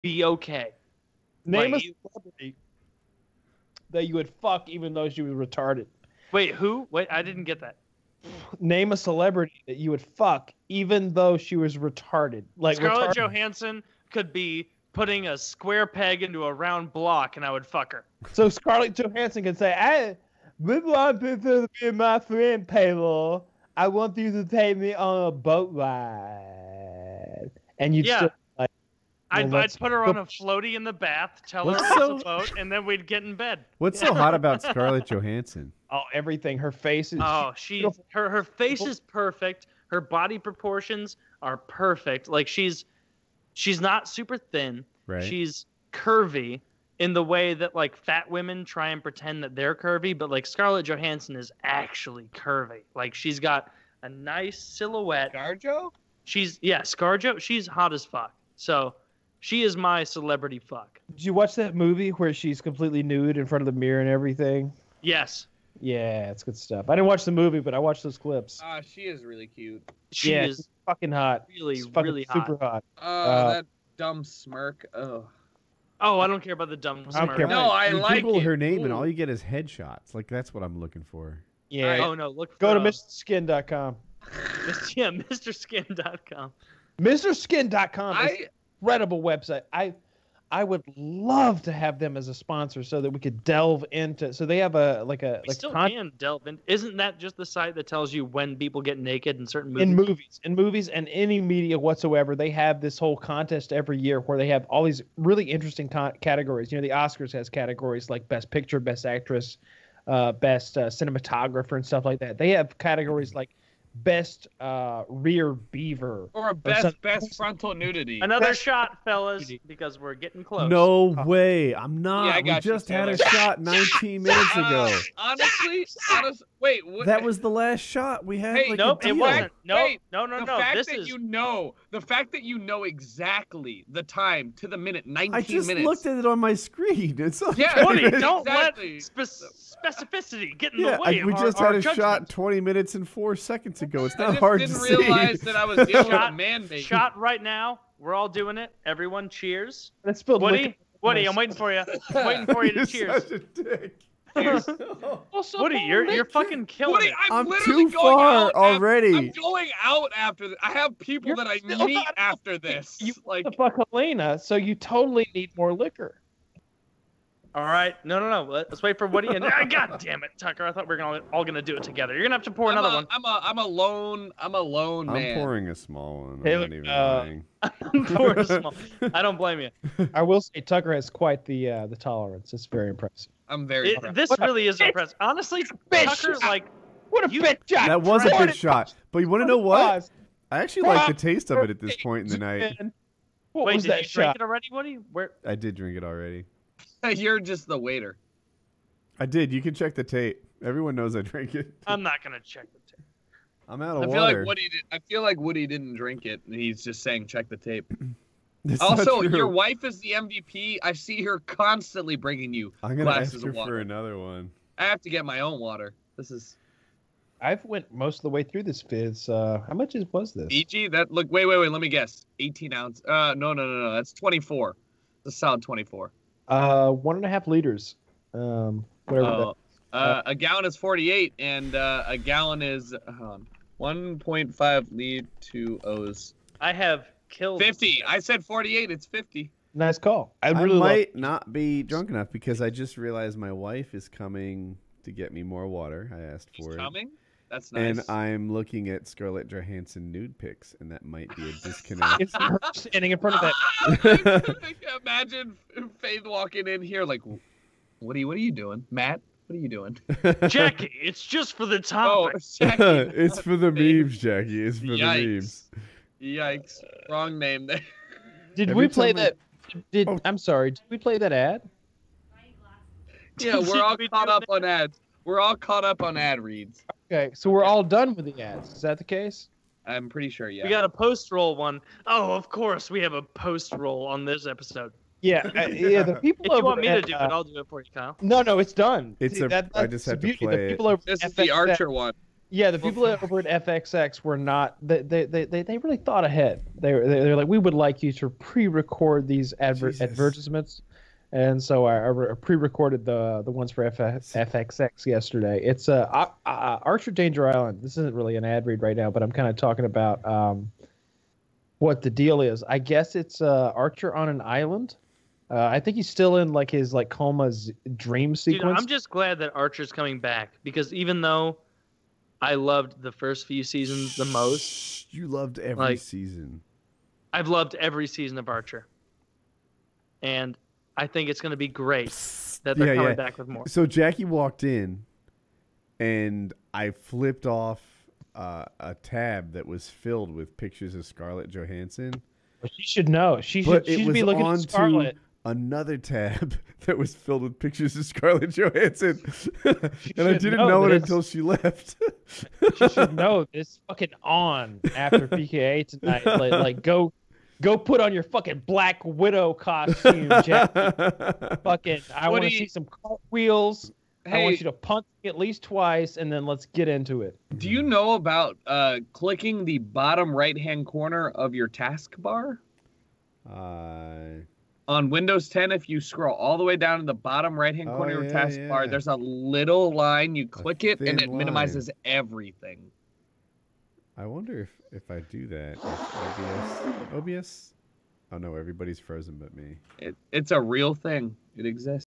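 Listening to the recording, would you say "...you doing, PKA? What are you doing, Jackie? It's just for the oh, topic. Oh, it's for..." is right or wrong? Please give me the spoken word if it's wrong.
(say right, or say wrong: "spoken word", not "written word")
wrong: "Matt", not "PKA".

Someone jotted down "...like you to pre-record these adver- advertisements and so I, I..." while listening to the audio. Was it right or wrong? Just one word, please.
right.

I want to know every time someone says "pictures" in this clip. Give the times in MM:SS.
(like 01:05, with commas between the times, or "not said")
01:48, 05:40, 05:47.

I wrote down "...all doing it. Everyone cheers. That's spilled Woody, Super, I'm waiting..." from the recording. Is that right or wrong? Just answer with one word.
wrong.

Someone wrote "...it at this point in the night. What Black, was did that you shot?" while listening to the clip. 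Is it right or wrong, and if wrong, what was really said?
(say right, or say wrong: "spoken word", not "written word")
wrong: "Wait", not "Black".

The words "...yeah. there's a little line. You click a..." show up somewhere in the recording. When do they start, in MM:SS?
06:18.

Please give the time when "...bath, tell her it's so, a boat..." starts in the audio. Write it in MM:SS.
00:30.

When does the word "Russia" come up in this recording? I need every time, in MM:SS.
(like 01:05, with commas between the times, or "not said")
not said.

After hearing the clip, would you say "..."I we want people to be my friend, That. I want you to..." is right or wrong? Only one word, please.
wrong.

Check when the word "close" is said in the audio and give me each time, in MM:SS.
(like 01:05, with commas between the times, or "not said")
02:00.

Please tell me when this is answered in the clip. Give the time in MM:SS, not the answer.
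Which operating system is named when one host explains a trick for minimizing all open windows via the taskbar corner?
06:15.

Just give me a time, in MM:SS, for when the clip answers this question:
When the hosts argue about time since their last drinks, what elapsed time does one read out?
02:22.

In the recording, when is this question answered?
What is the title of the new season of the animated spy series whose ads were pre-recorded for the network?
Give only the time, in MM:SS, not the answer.
05:06.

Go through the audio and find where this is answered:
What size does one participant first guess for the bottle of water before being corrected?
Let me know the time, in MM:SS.
03:42.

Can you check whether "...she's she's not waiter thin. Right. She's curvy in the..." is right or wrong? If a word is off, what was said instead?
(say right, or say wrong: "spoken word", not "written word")
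wrong: "super", not "waiter".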